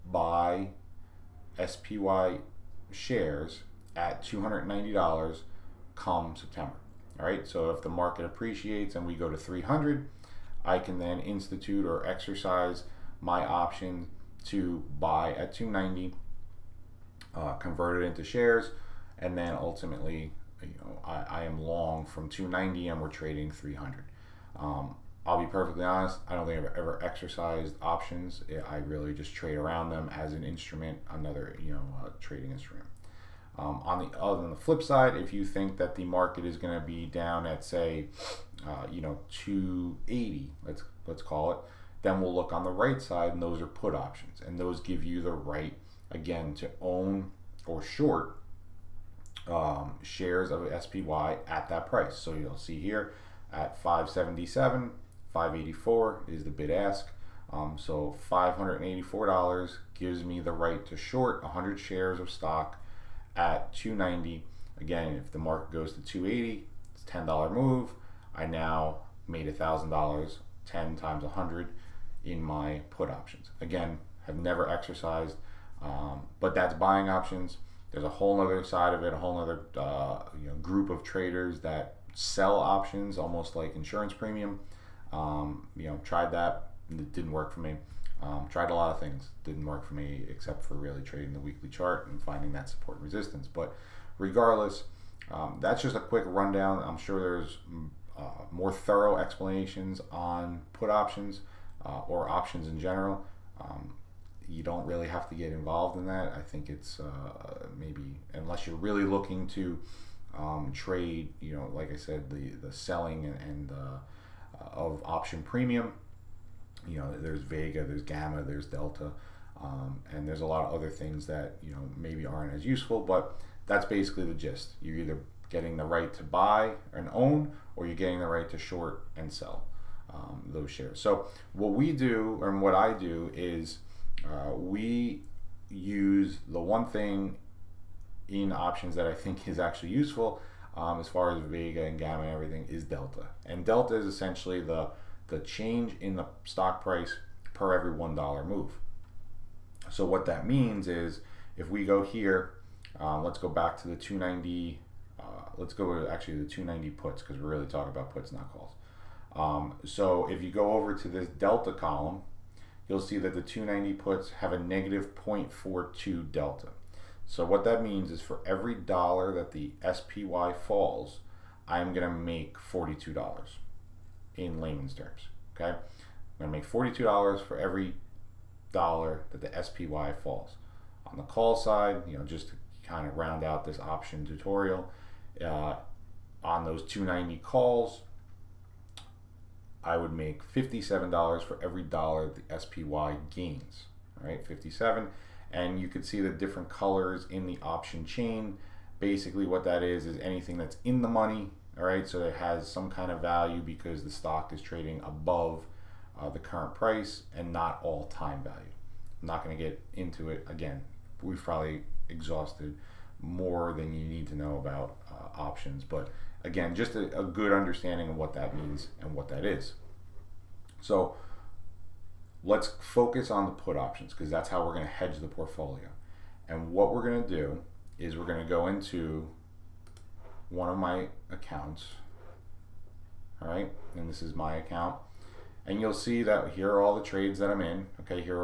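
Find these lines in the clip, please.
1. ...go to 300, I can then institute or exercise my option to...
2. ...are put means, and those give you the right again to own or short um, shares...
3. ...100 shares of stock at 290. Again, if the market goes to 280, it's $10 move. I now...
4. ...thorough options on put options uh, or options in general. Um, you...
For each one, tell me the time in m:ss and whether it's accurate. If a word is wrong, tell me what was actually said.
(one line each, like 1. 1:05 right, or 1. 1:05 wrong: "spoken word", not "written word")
1. 0:09 right
2. 0:43 wrong: "options", not "means"
3. 1:01 right
4. 1:38 wrong: "explanations", not "options".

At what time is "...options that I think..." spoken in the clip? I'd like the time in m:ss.
2:18.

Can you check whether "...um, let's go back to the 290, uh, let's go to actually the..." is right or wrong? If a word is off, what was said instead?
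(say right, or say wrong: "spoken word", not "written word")
right.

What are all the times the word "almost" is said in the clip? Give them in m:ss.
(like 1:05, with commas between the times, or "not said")
1:23.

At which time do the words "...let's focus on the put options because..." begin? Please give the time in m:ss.
3:42.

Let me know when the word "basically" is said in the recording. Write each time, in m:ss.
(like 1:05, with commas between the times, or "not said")
2:03, 3:18.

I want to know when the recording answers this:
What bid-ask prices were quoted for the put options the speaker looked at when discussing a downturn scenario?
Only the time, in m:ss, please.
0:53.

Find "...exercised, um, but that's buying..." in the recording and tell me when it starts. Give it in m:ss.
1:14.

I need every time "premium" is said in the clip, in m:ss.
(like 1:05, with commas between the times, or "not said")
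1:24, 1:55.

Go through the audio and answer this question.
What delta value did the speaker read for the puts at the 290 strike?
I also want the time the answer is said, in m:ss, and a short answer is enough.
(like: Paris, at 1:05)
-0.42, at 2:44.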